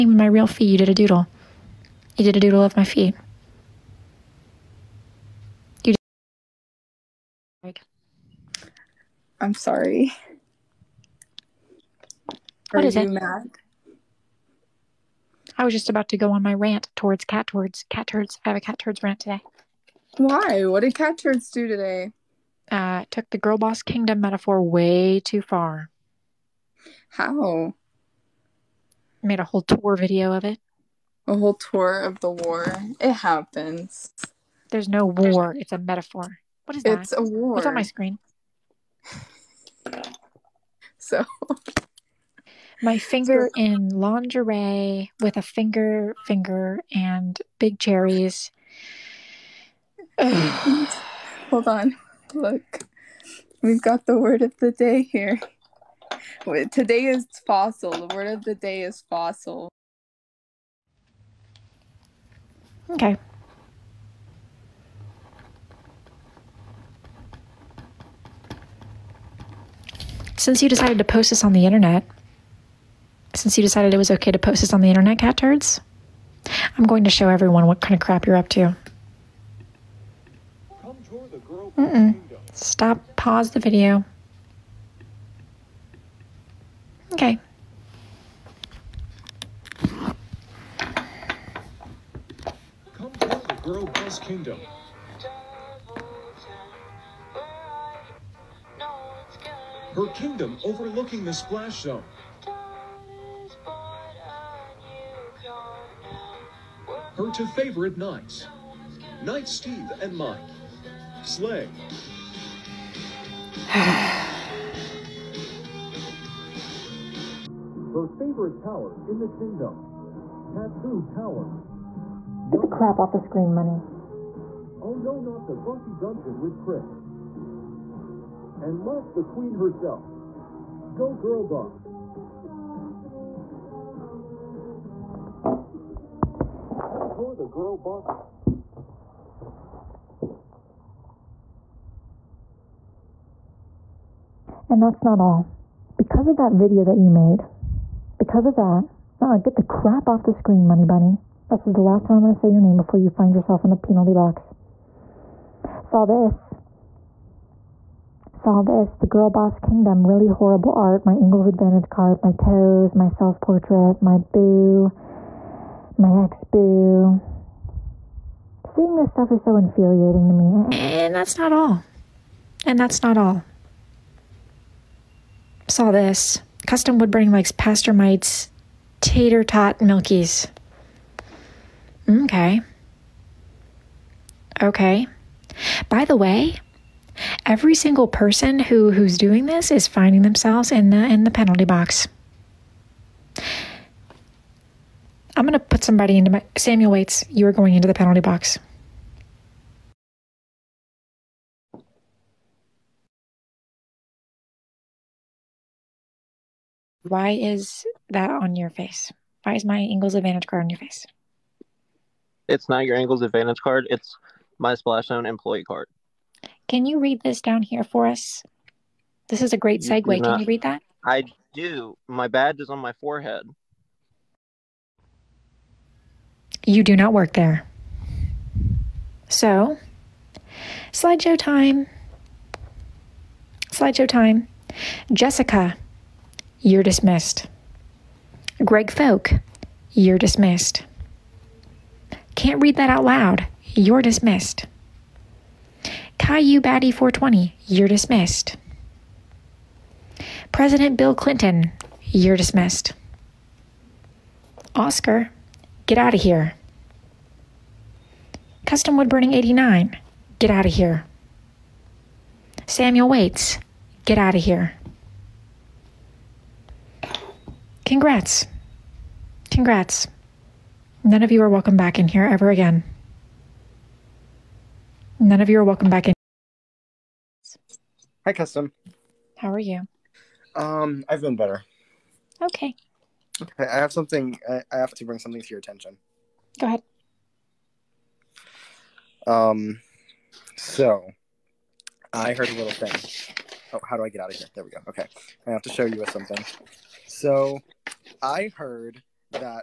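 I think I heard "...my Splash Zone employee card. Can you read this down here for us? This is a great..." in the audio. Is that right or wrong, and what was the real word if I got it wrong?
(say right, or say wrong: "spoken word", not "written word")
right.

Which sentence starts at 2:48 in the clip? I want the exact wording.
Seeing this stuff is so infuriating to me, and that's not all.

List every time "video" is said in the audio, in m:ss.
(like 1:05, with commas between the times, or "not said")
0:29, 1:23, 2:26.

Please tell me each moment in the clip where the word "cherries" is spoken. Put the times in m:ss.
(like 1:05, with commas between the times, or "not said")
0:47.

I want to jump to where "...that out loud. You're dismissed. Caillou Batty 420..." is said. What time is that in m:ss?
4:02.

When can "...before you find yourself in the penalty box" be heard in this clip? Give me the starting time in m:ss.
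2:32.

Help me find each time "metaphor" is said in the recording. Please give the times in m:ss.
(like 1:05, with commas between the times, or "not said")
0:24, 0:35.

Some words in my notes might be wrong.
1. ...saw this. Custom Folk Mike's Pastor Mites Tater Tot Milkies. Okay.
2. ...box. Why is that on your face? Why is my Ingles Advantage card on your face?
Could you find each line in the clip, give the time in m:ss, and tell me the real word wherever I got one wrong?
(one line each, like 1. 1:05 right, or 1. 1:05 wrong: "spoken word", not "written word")
1. 2:55 wrong: "Woodburning", not "Folk"
2. 3:18 right.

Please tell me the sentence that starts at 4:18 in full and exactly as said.
Custom Wood Burning 89, get out of here.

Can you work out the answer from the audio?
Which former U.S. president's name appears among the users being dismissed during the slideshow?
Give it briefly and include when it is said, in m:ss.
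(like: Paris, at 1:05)
Bill Clinton, at 4:10.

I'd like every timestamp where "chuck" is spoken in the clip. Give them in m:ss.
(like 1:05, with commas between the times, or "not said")
not said.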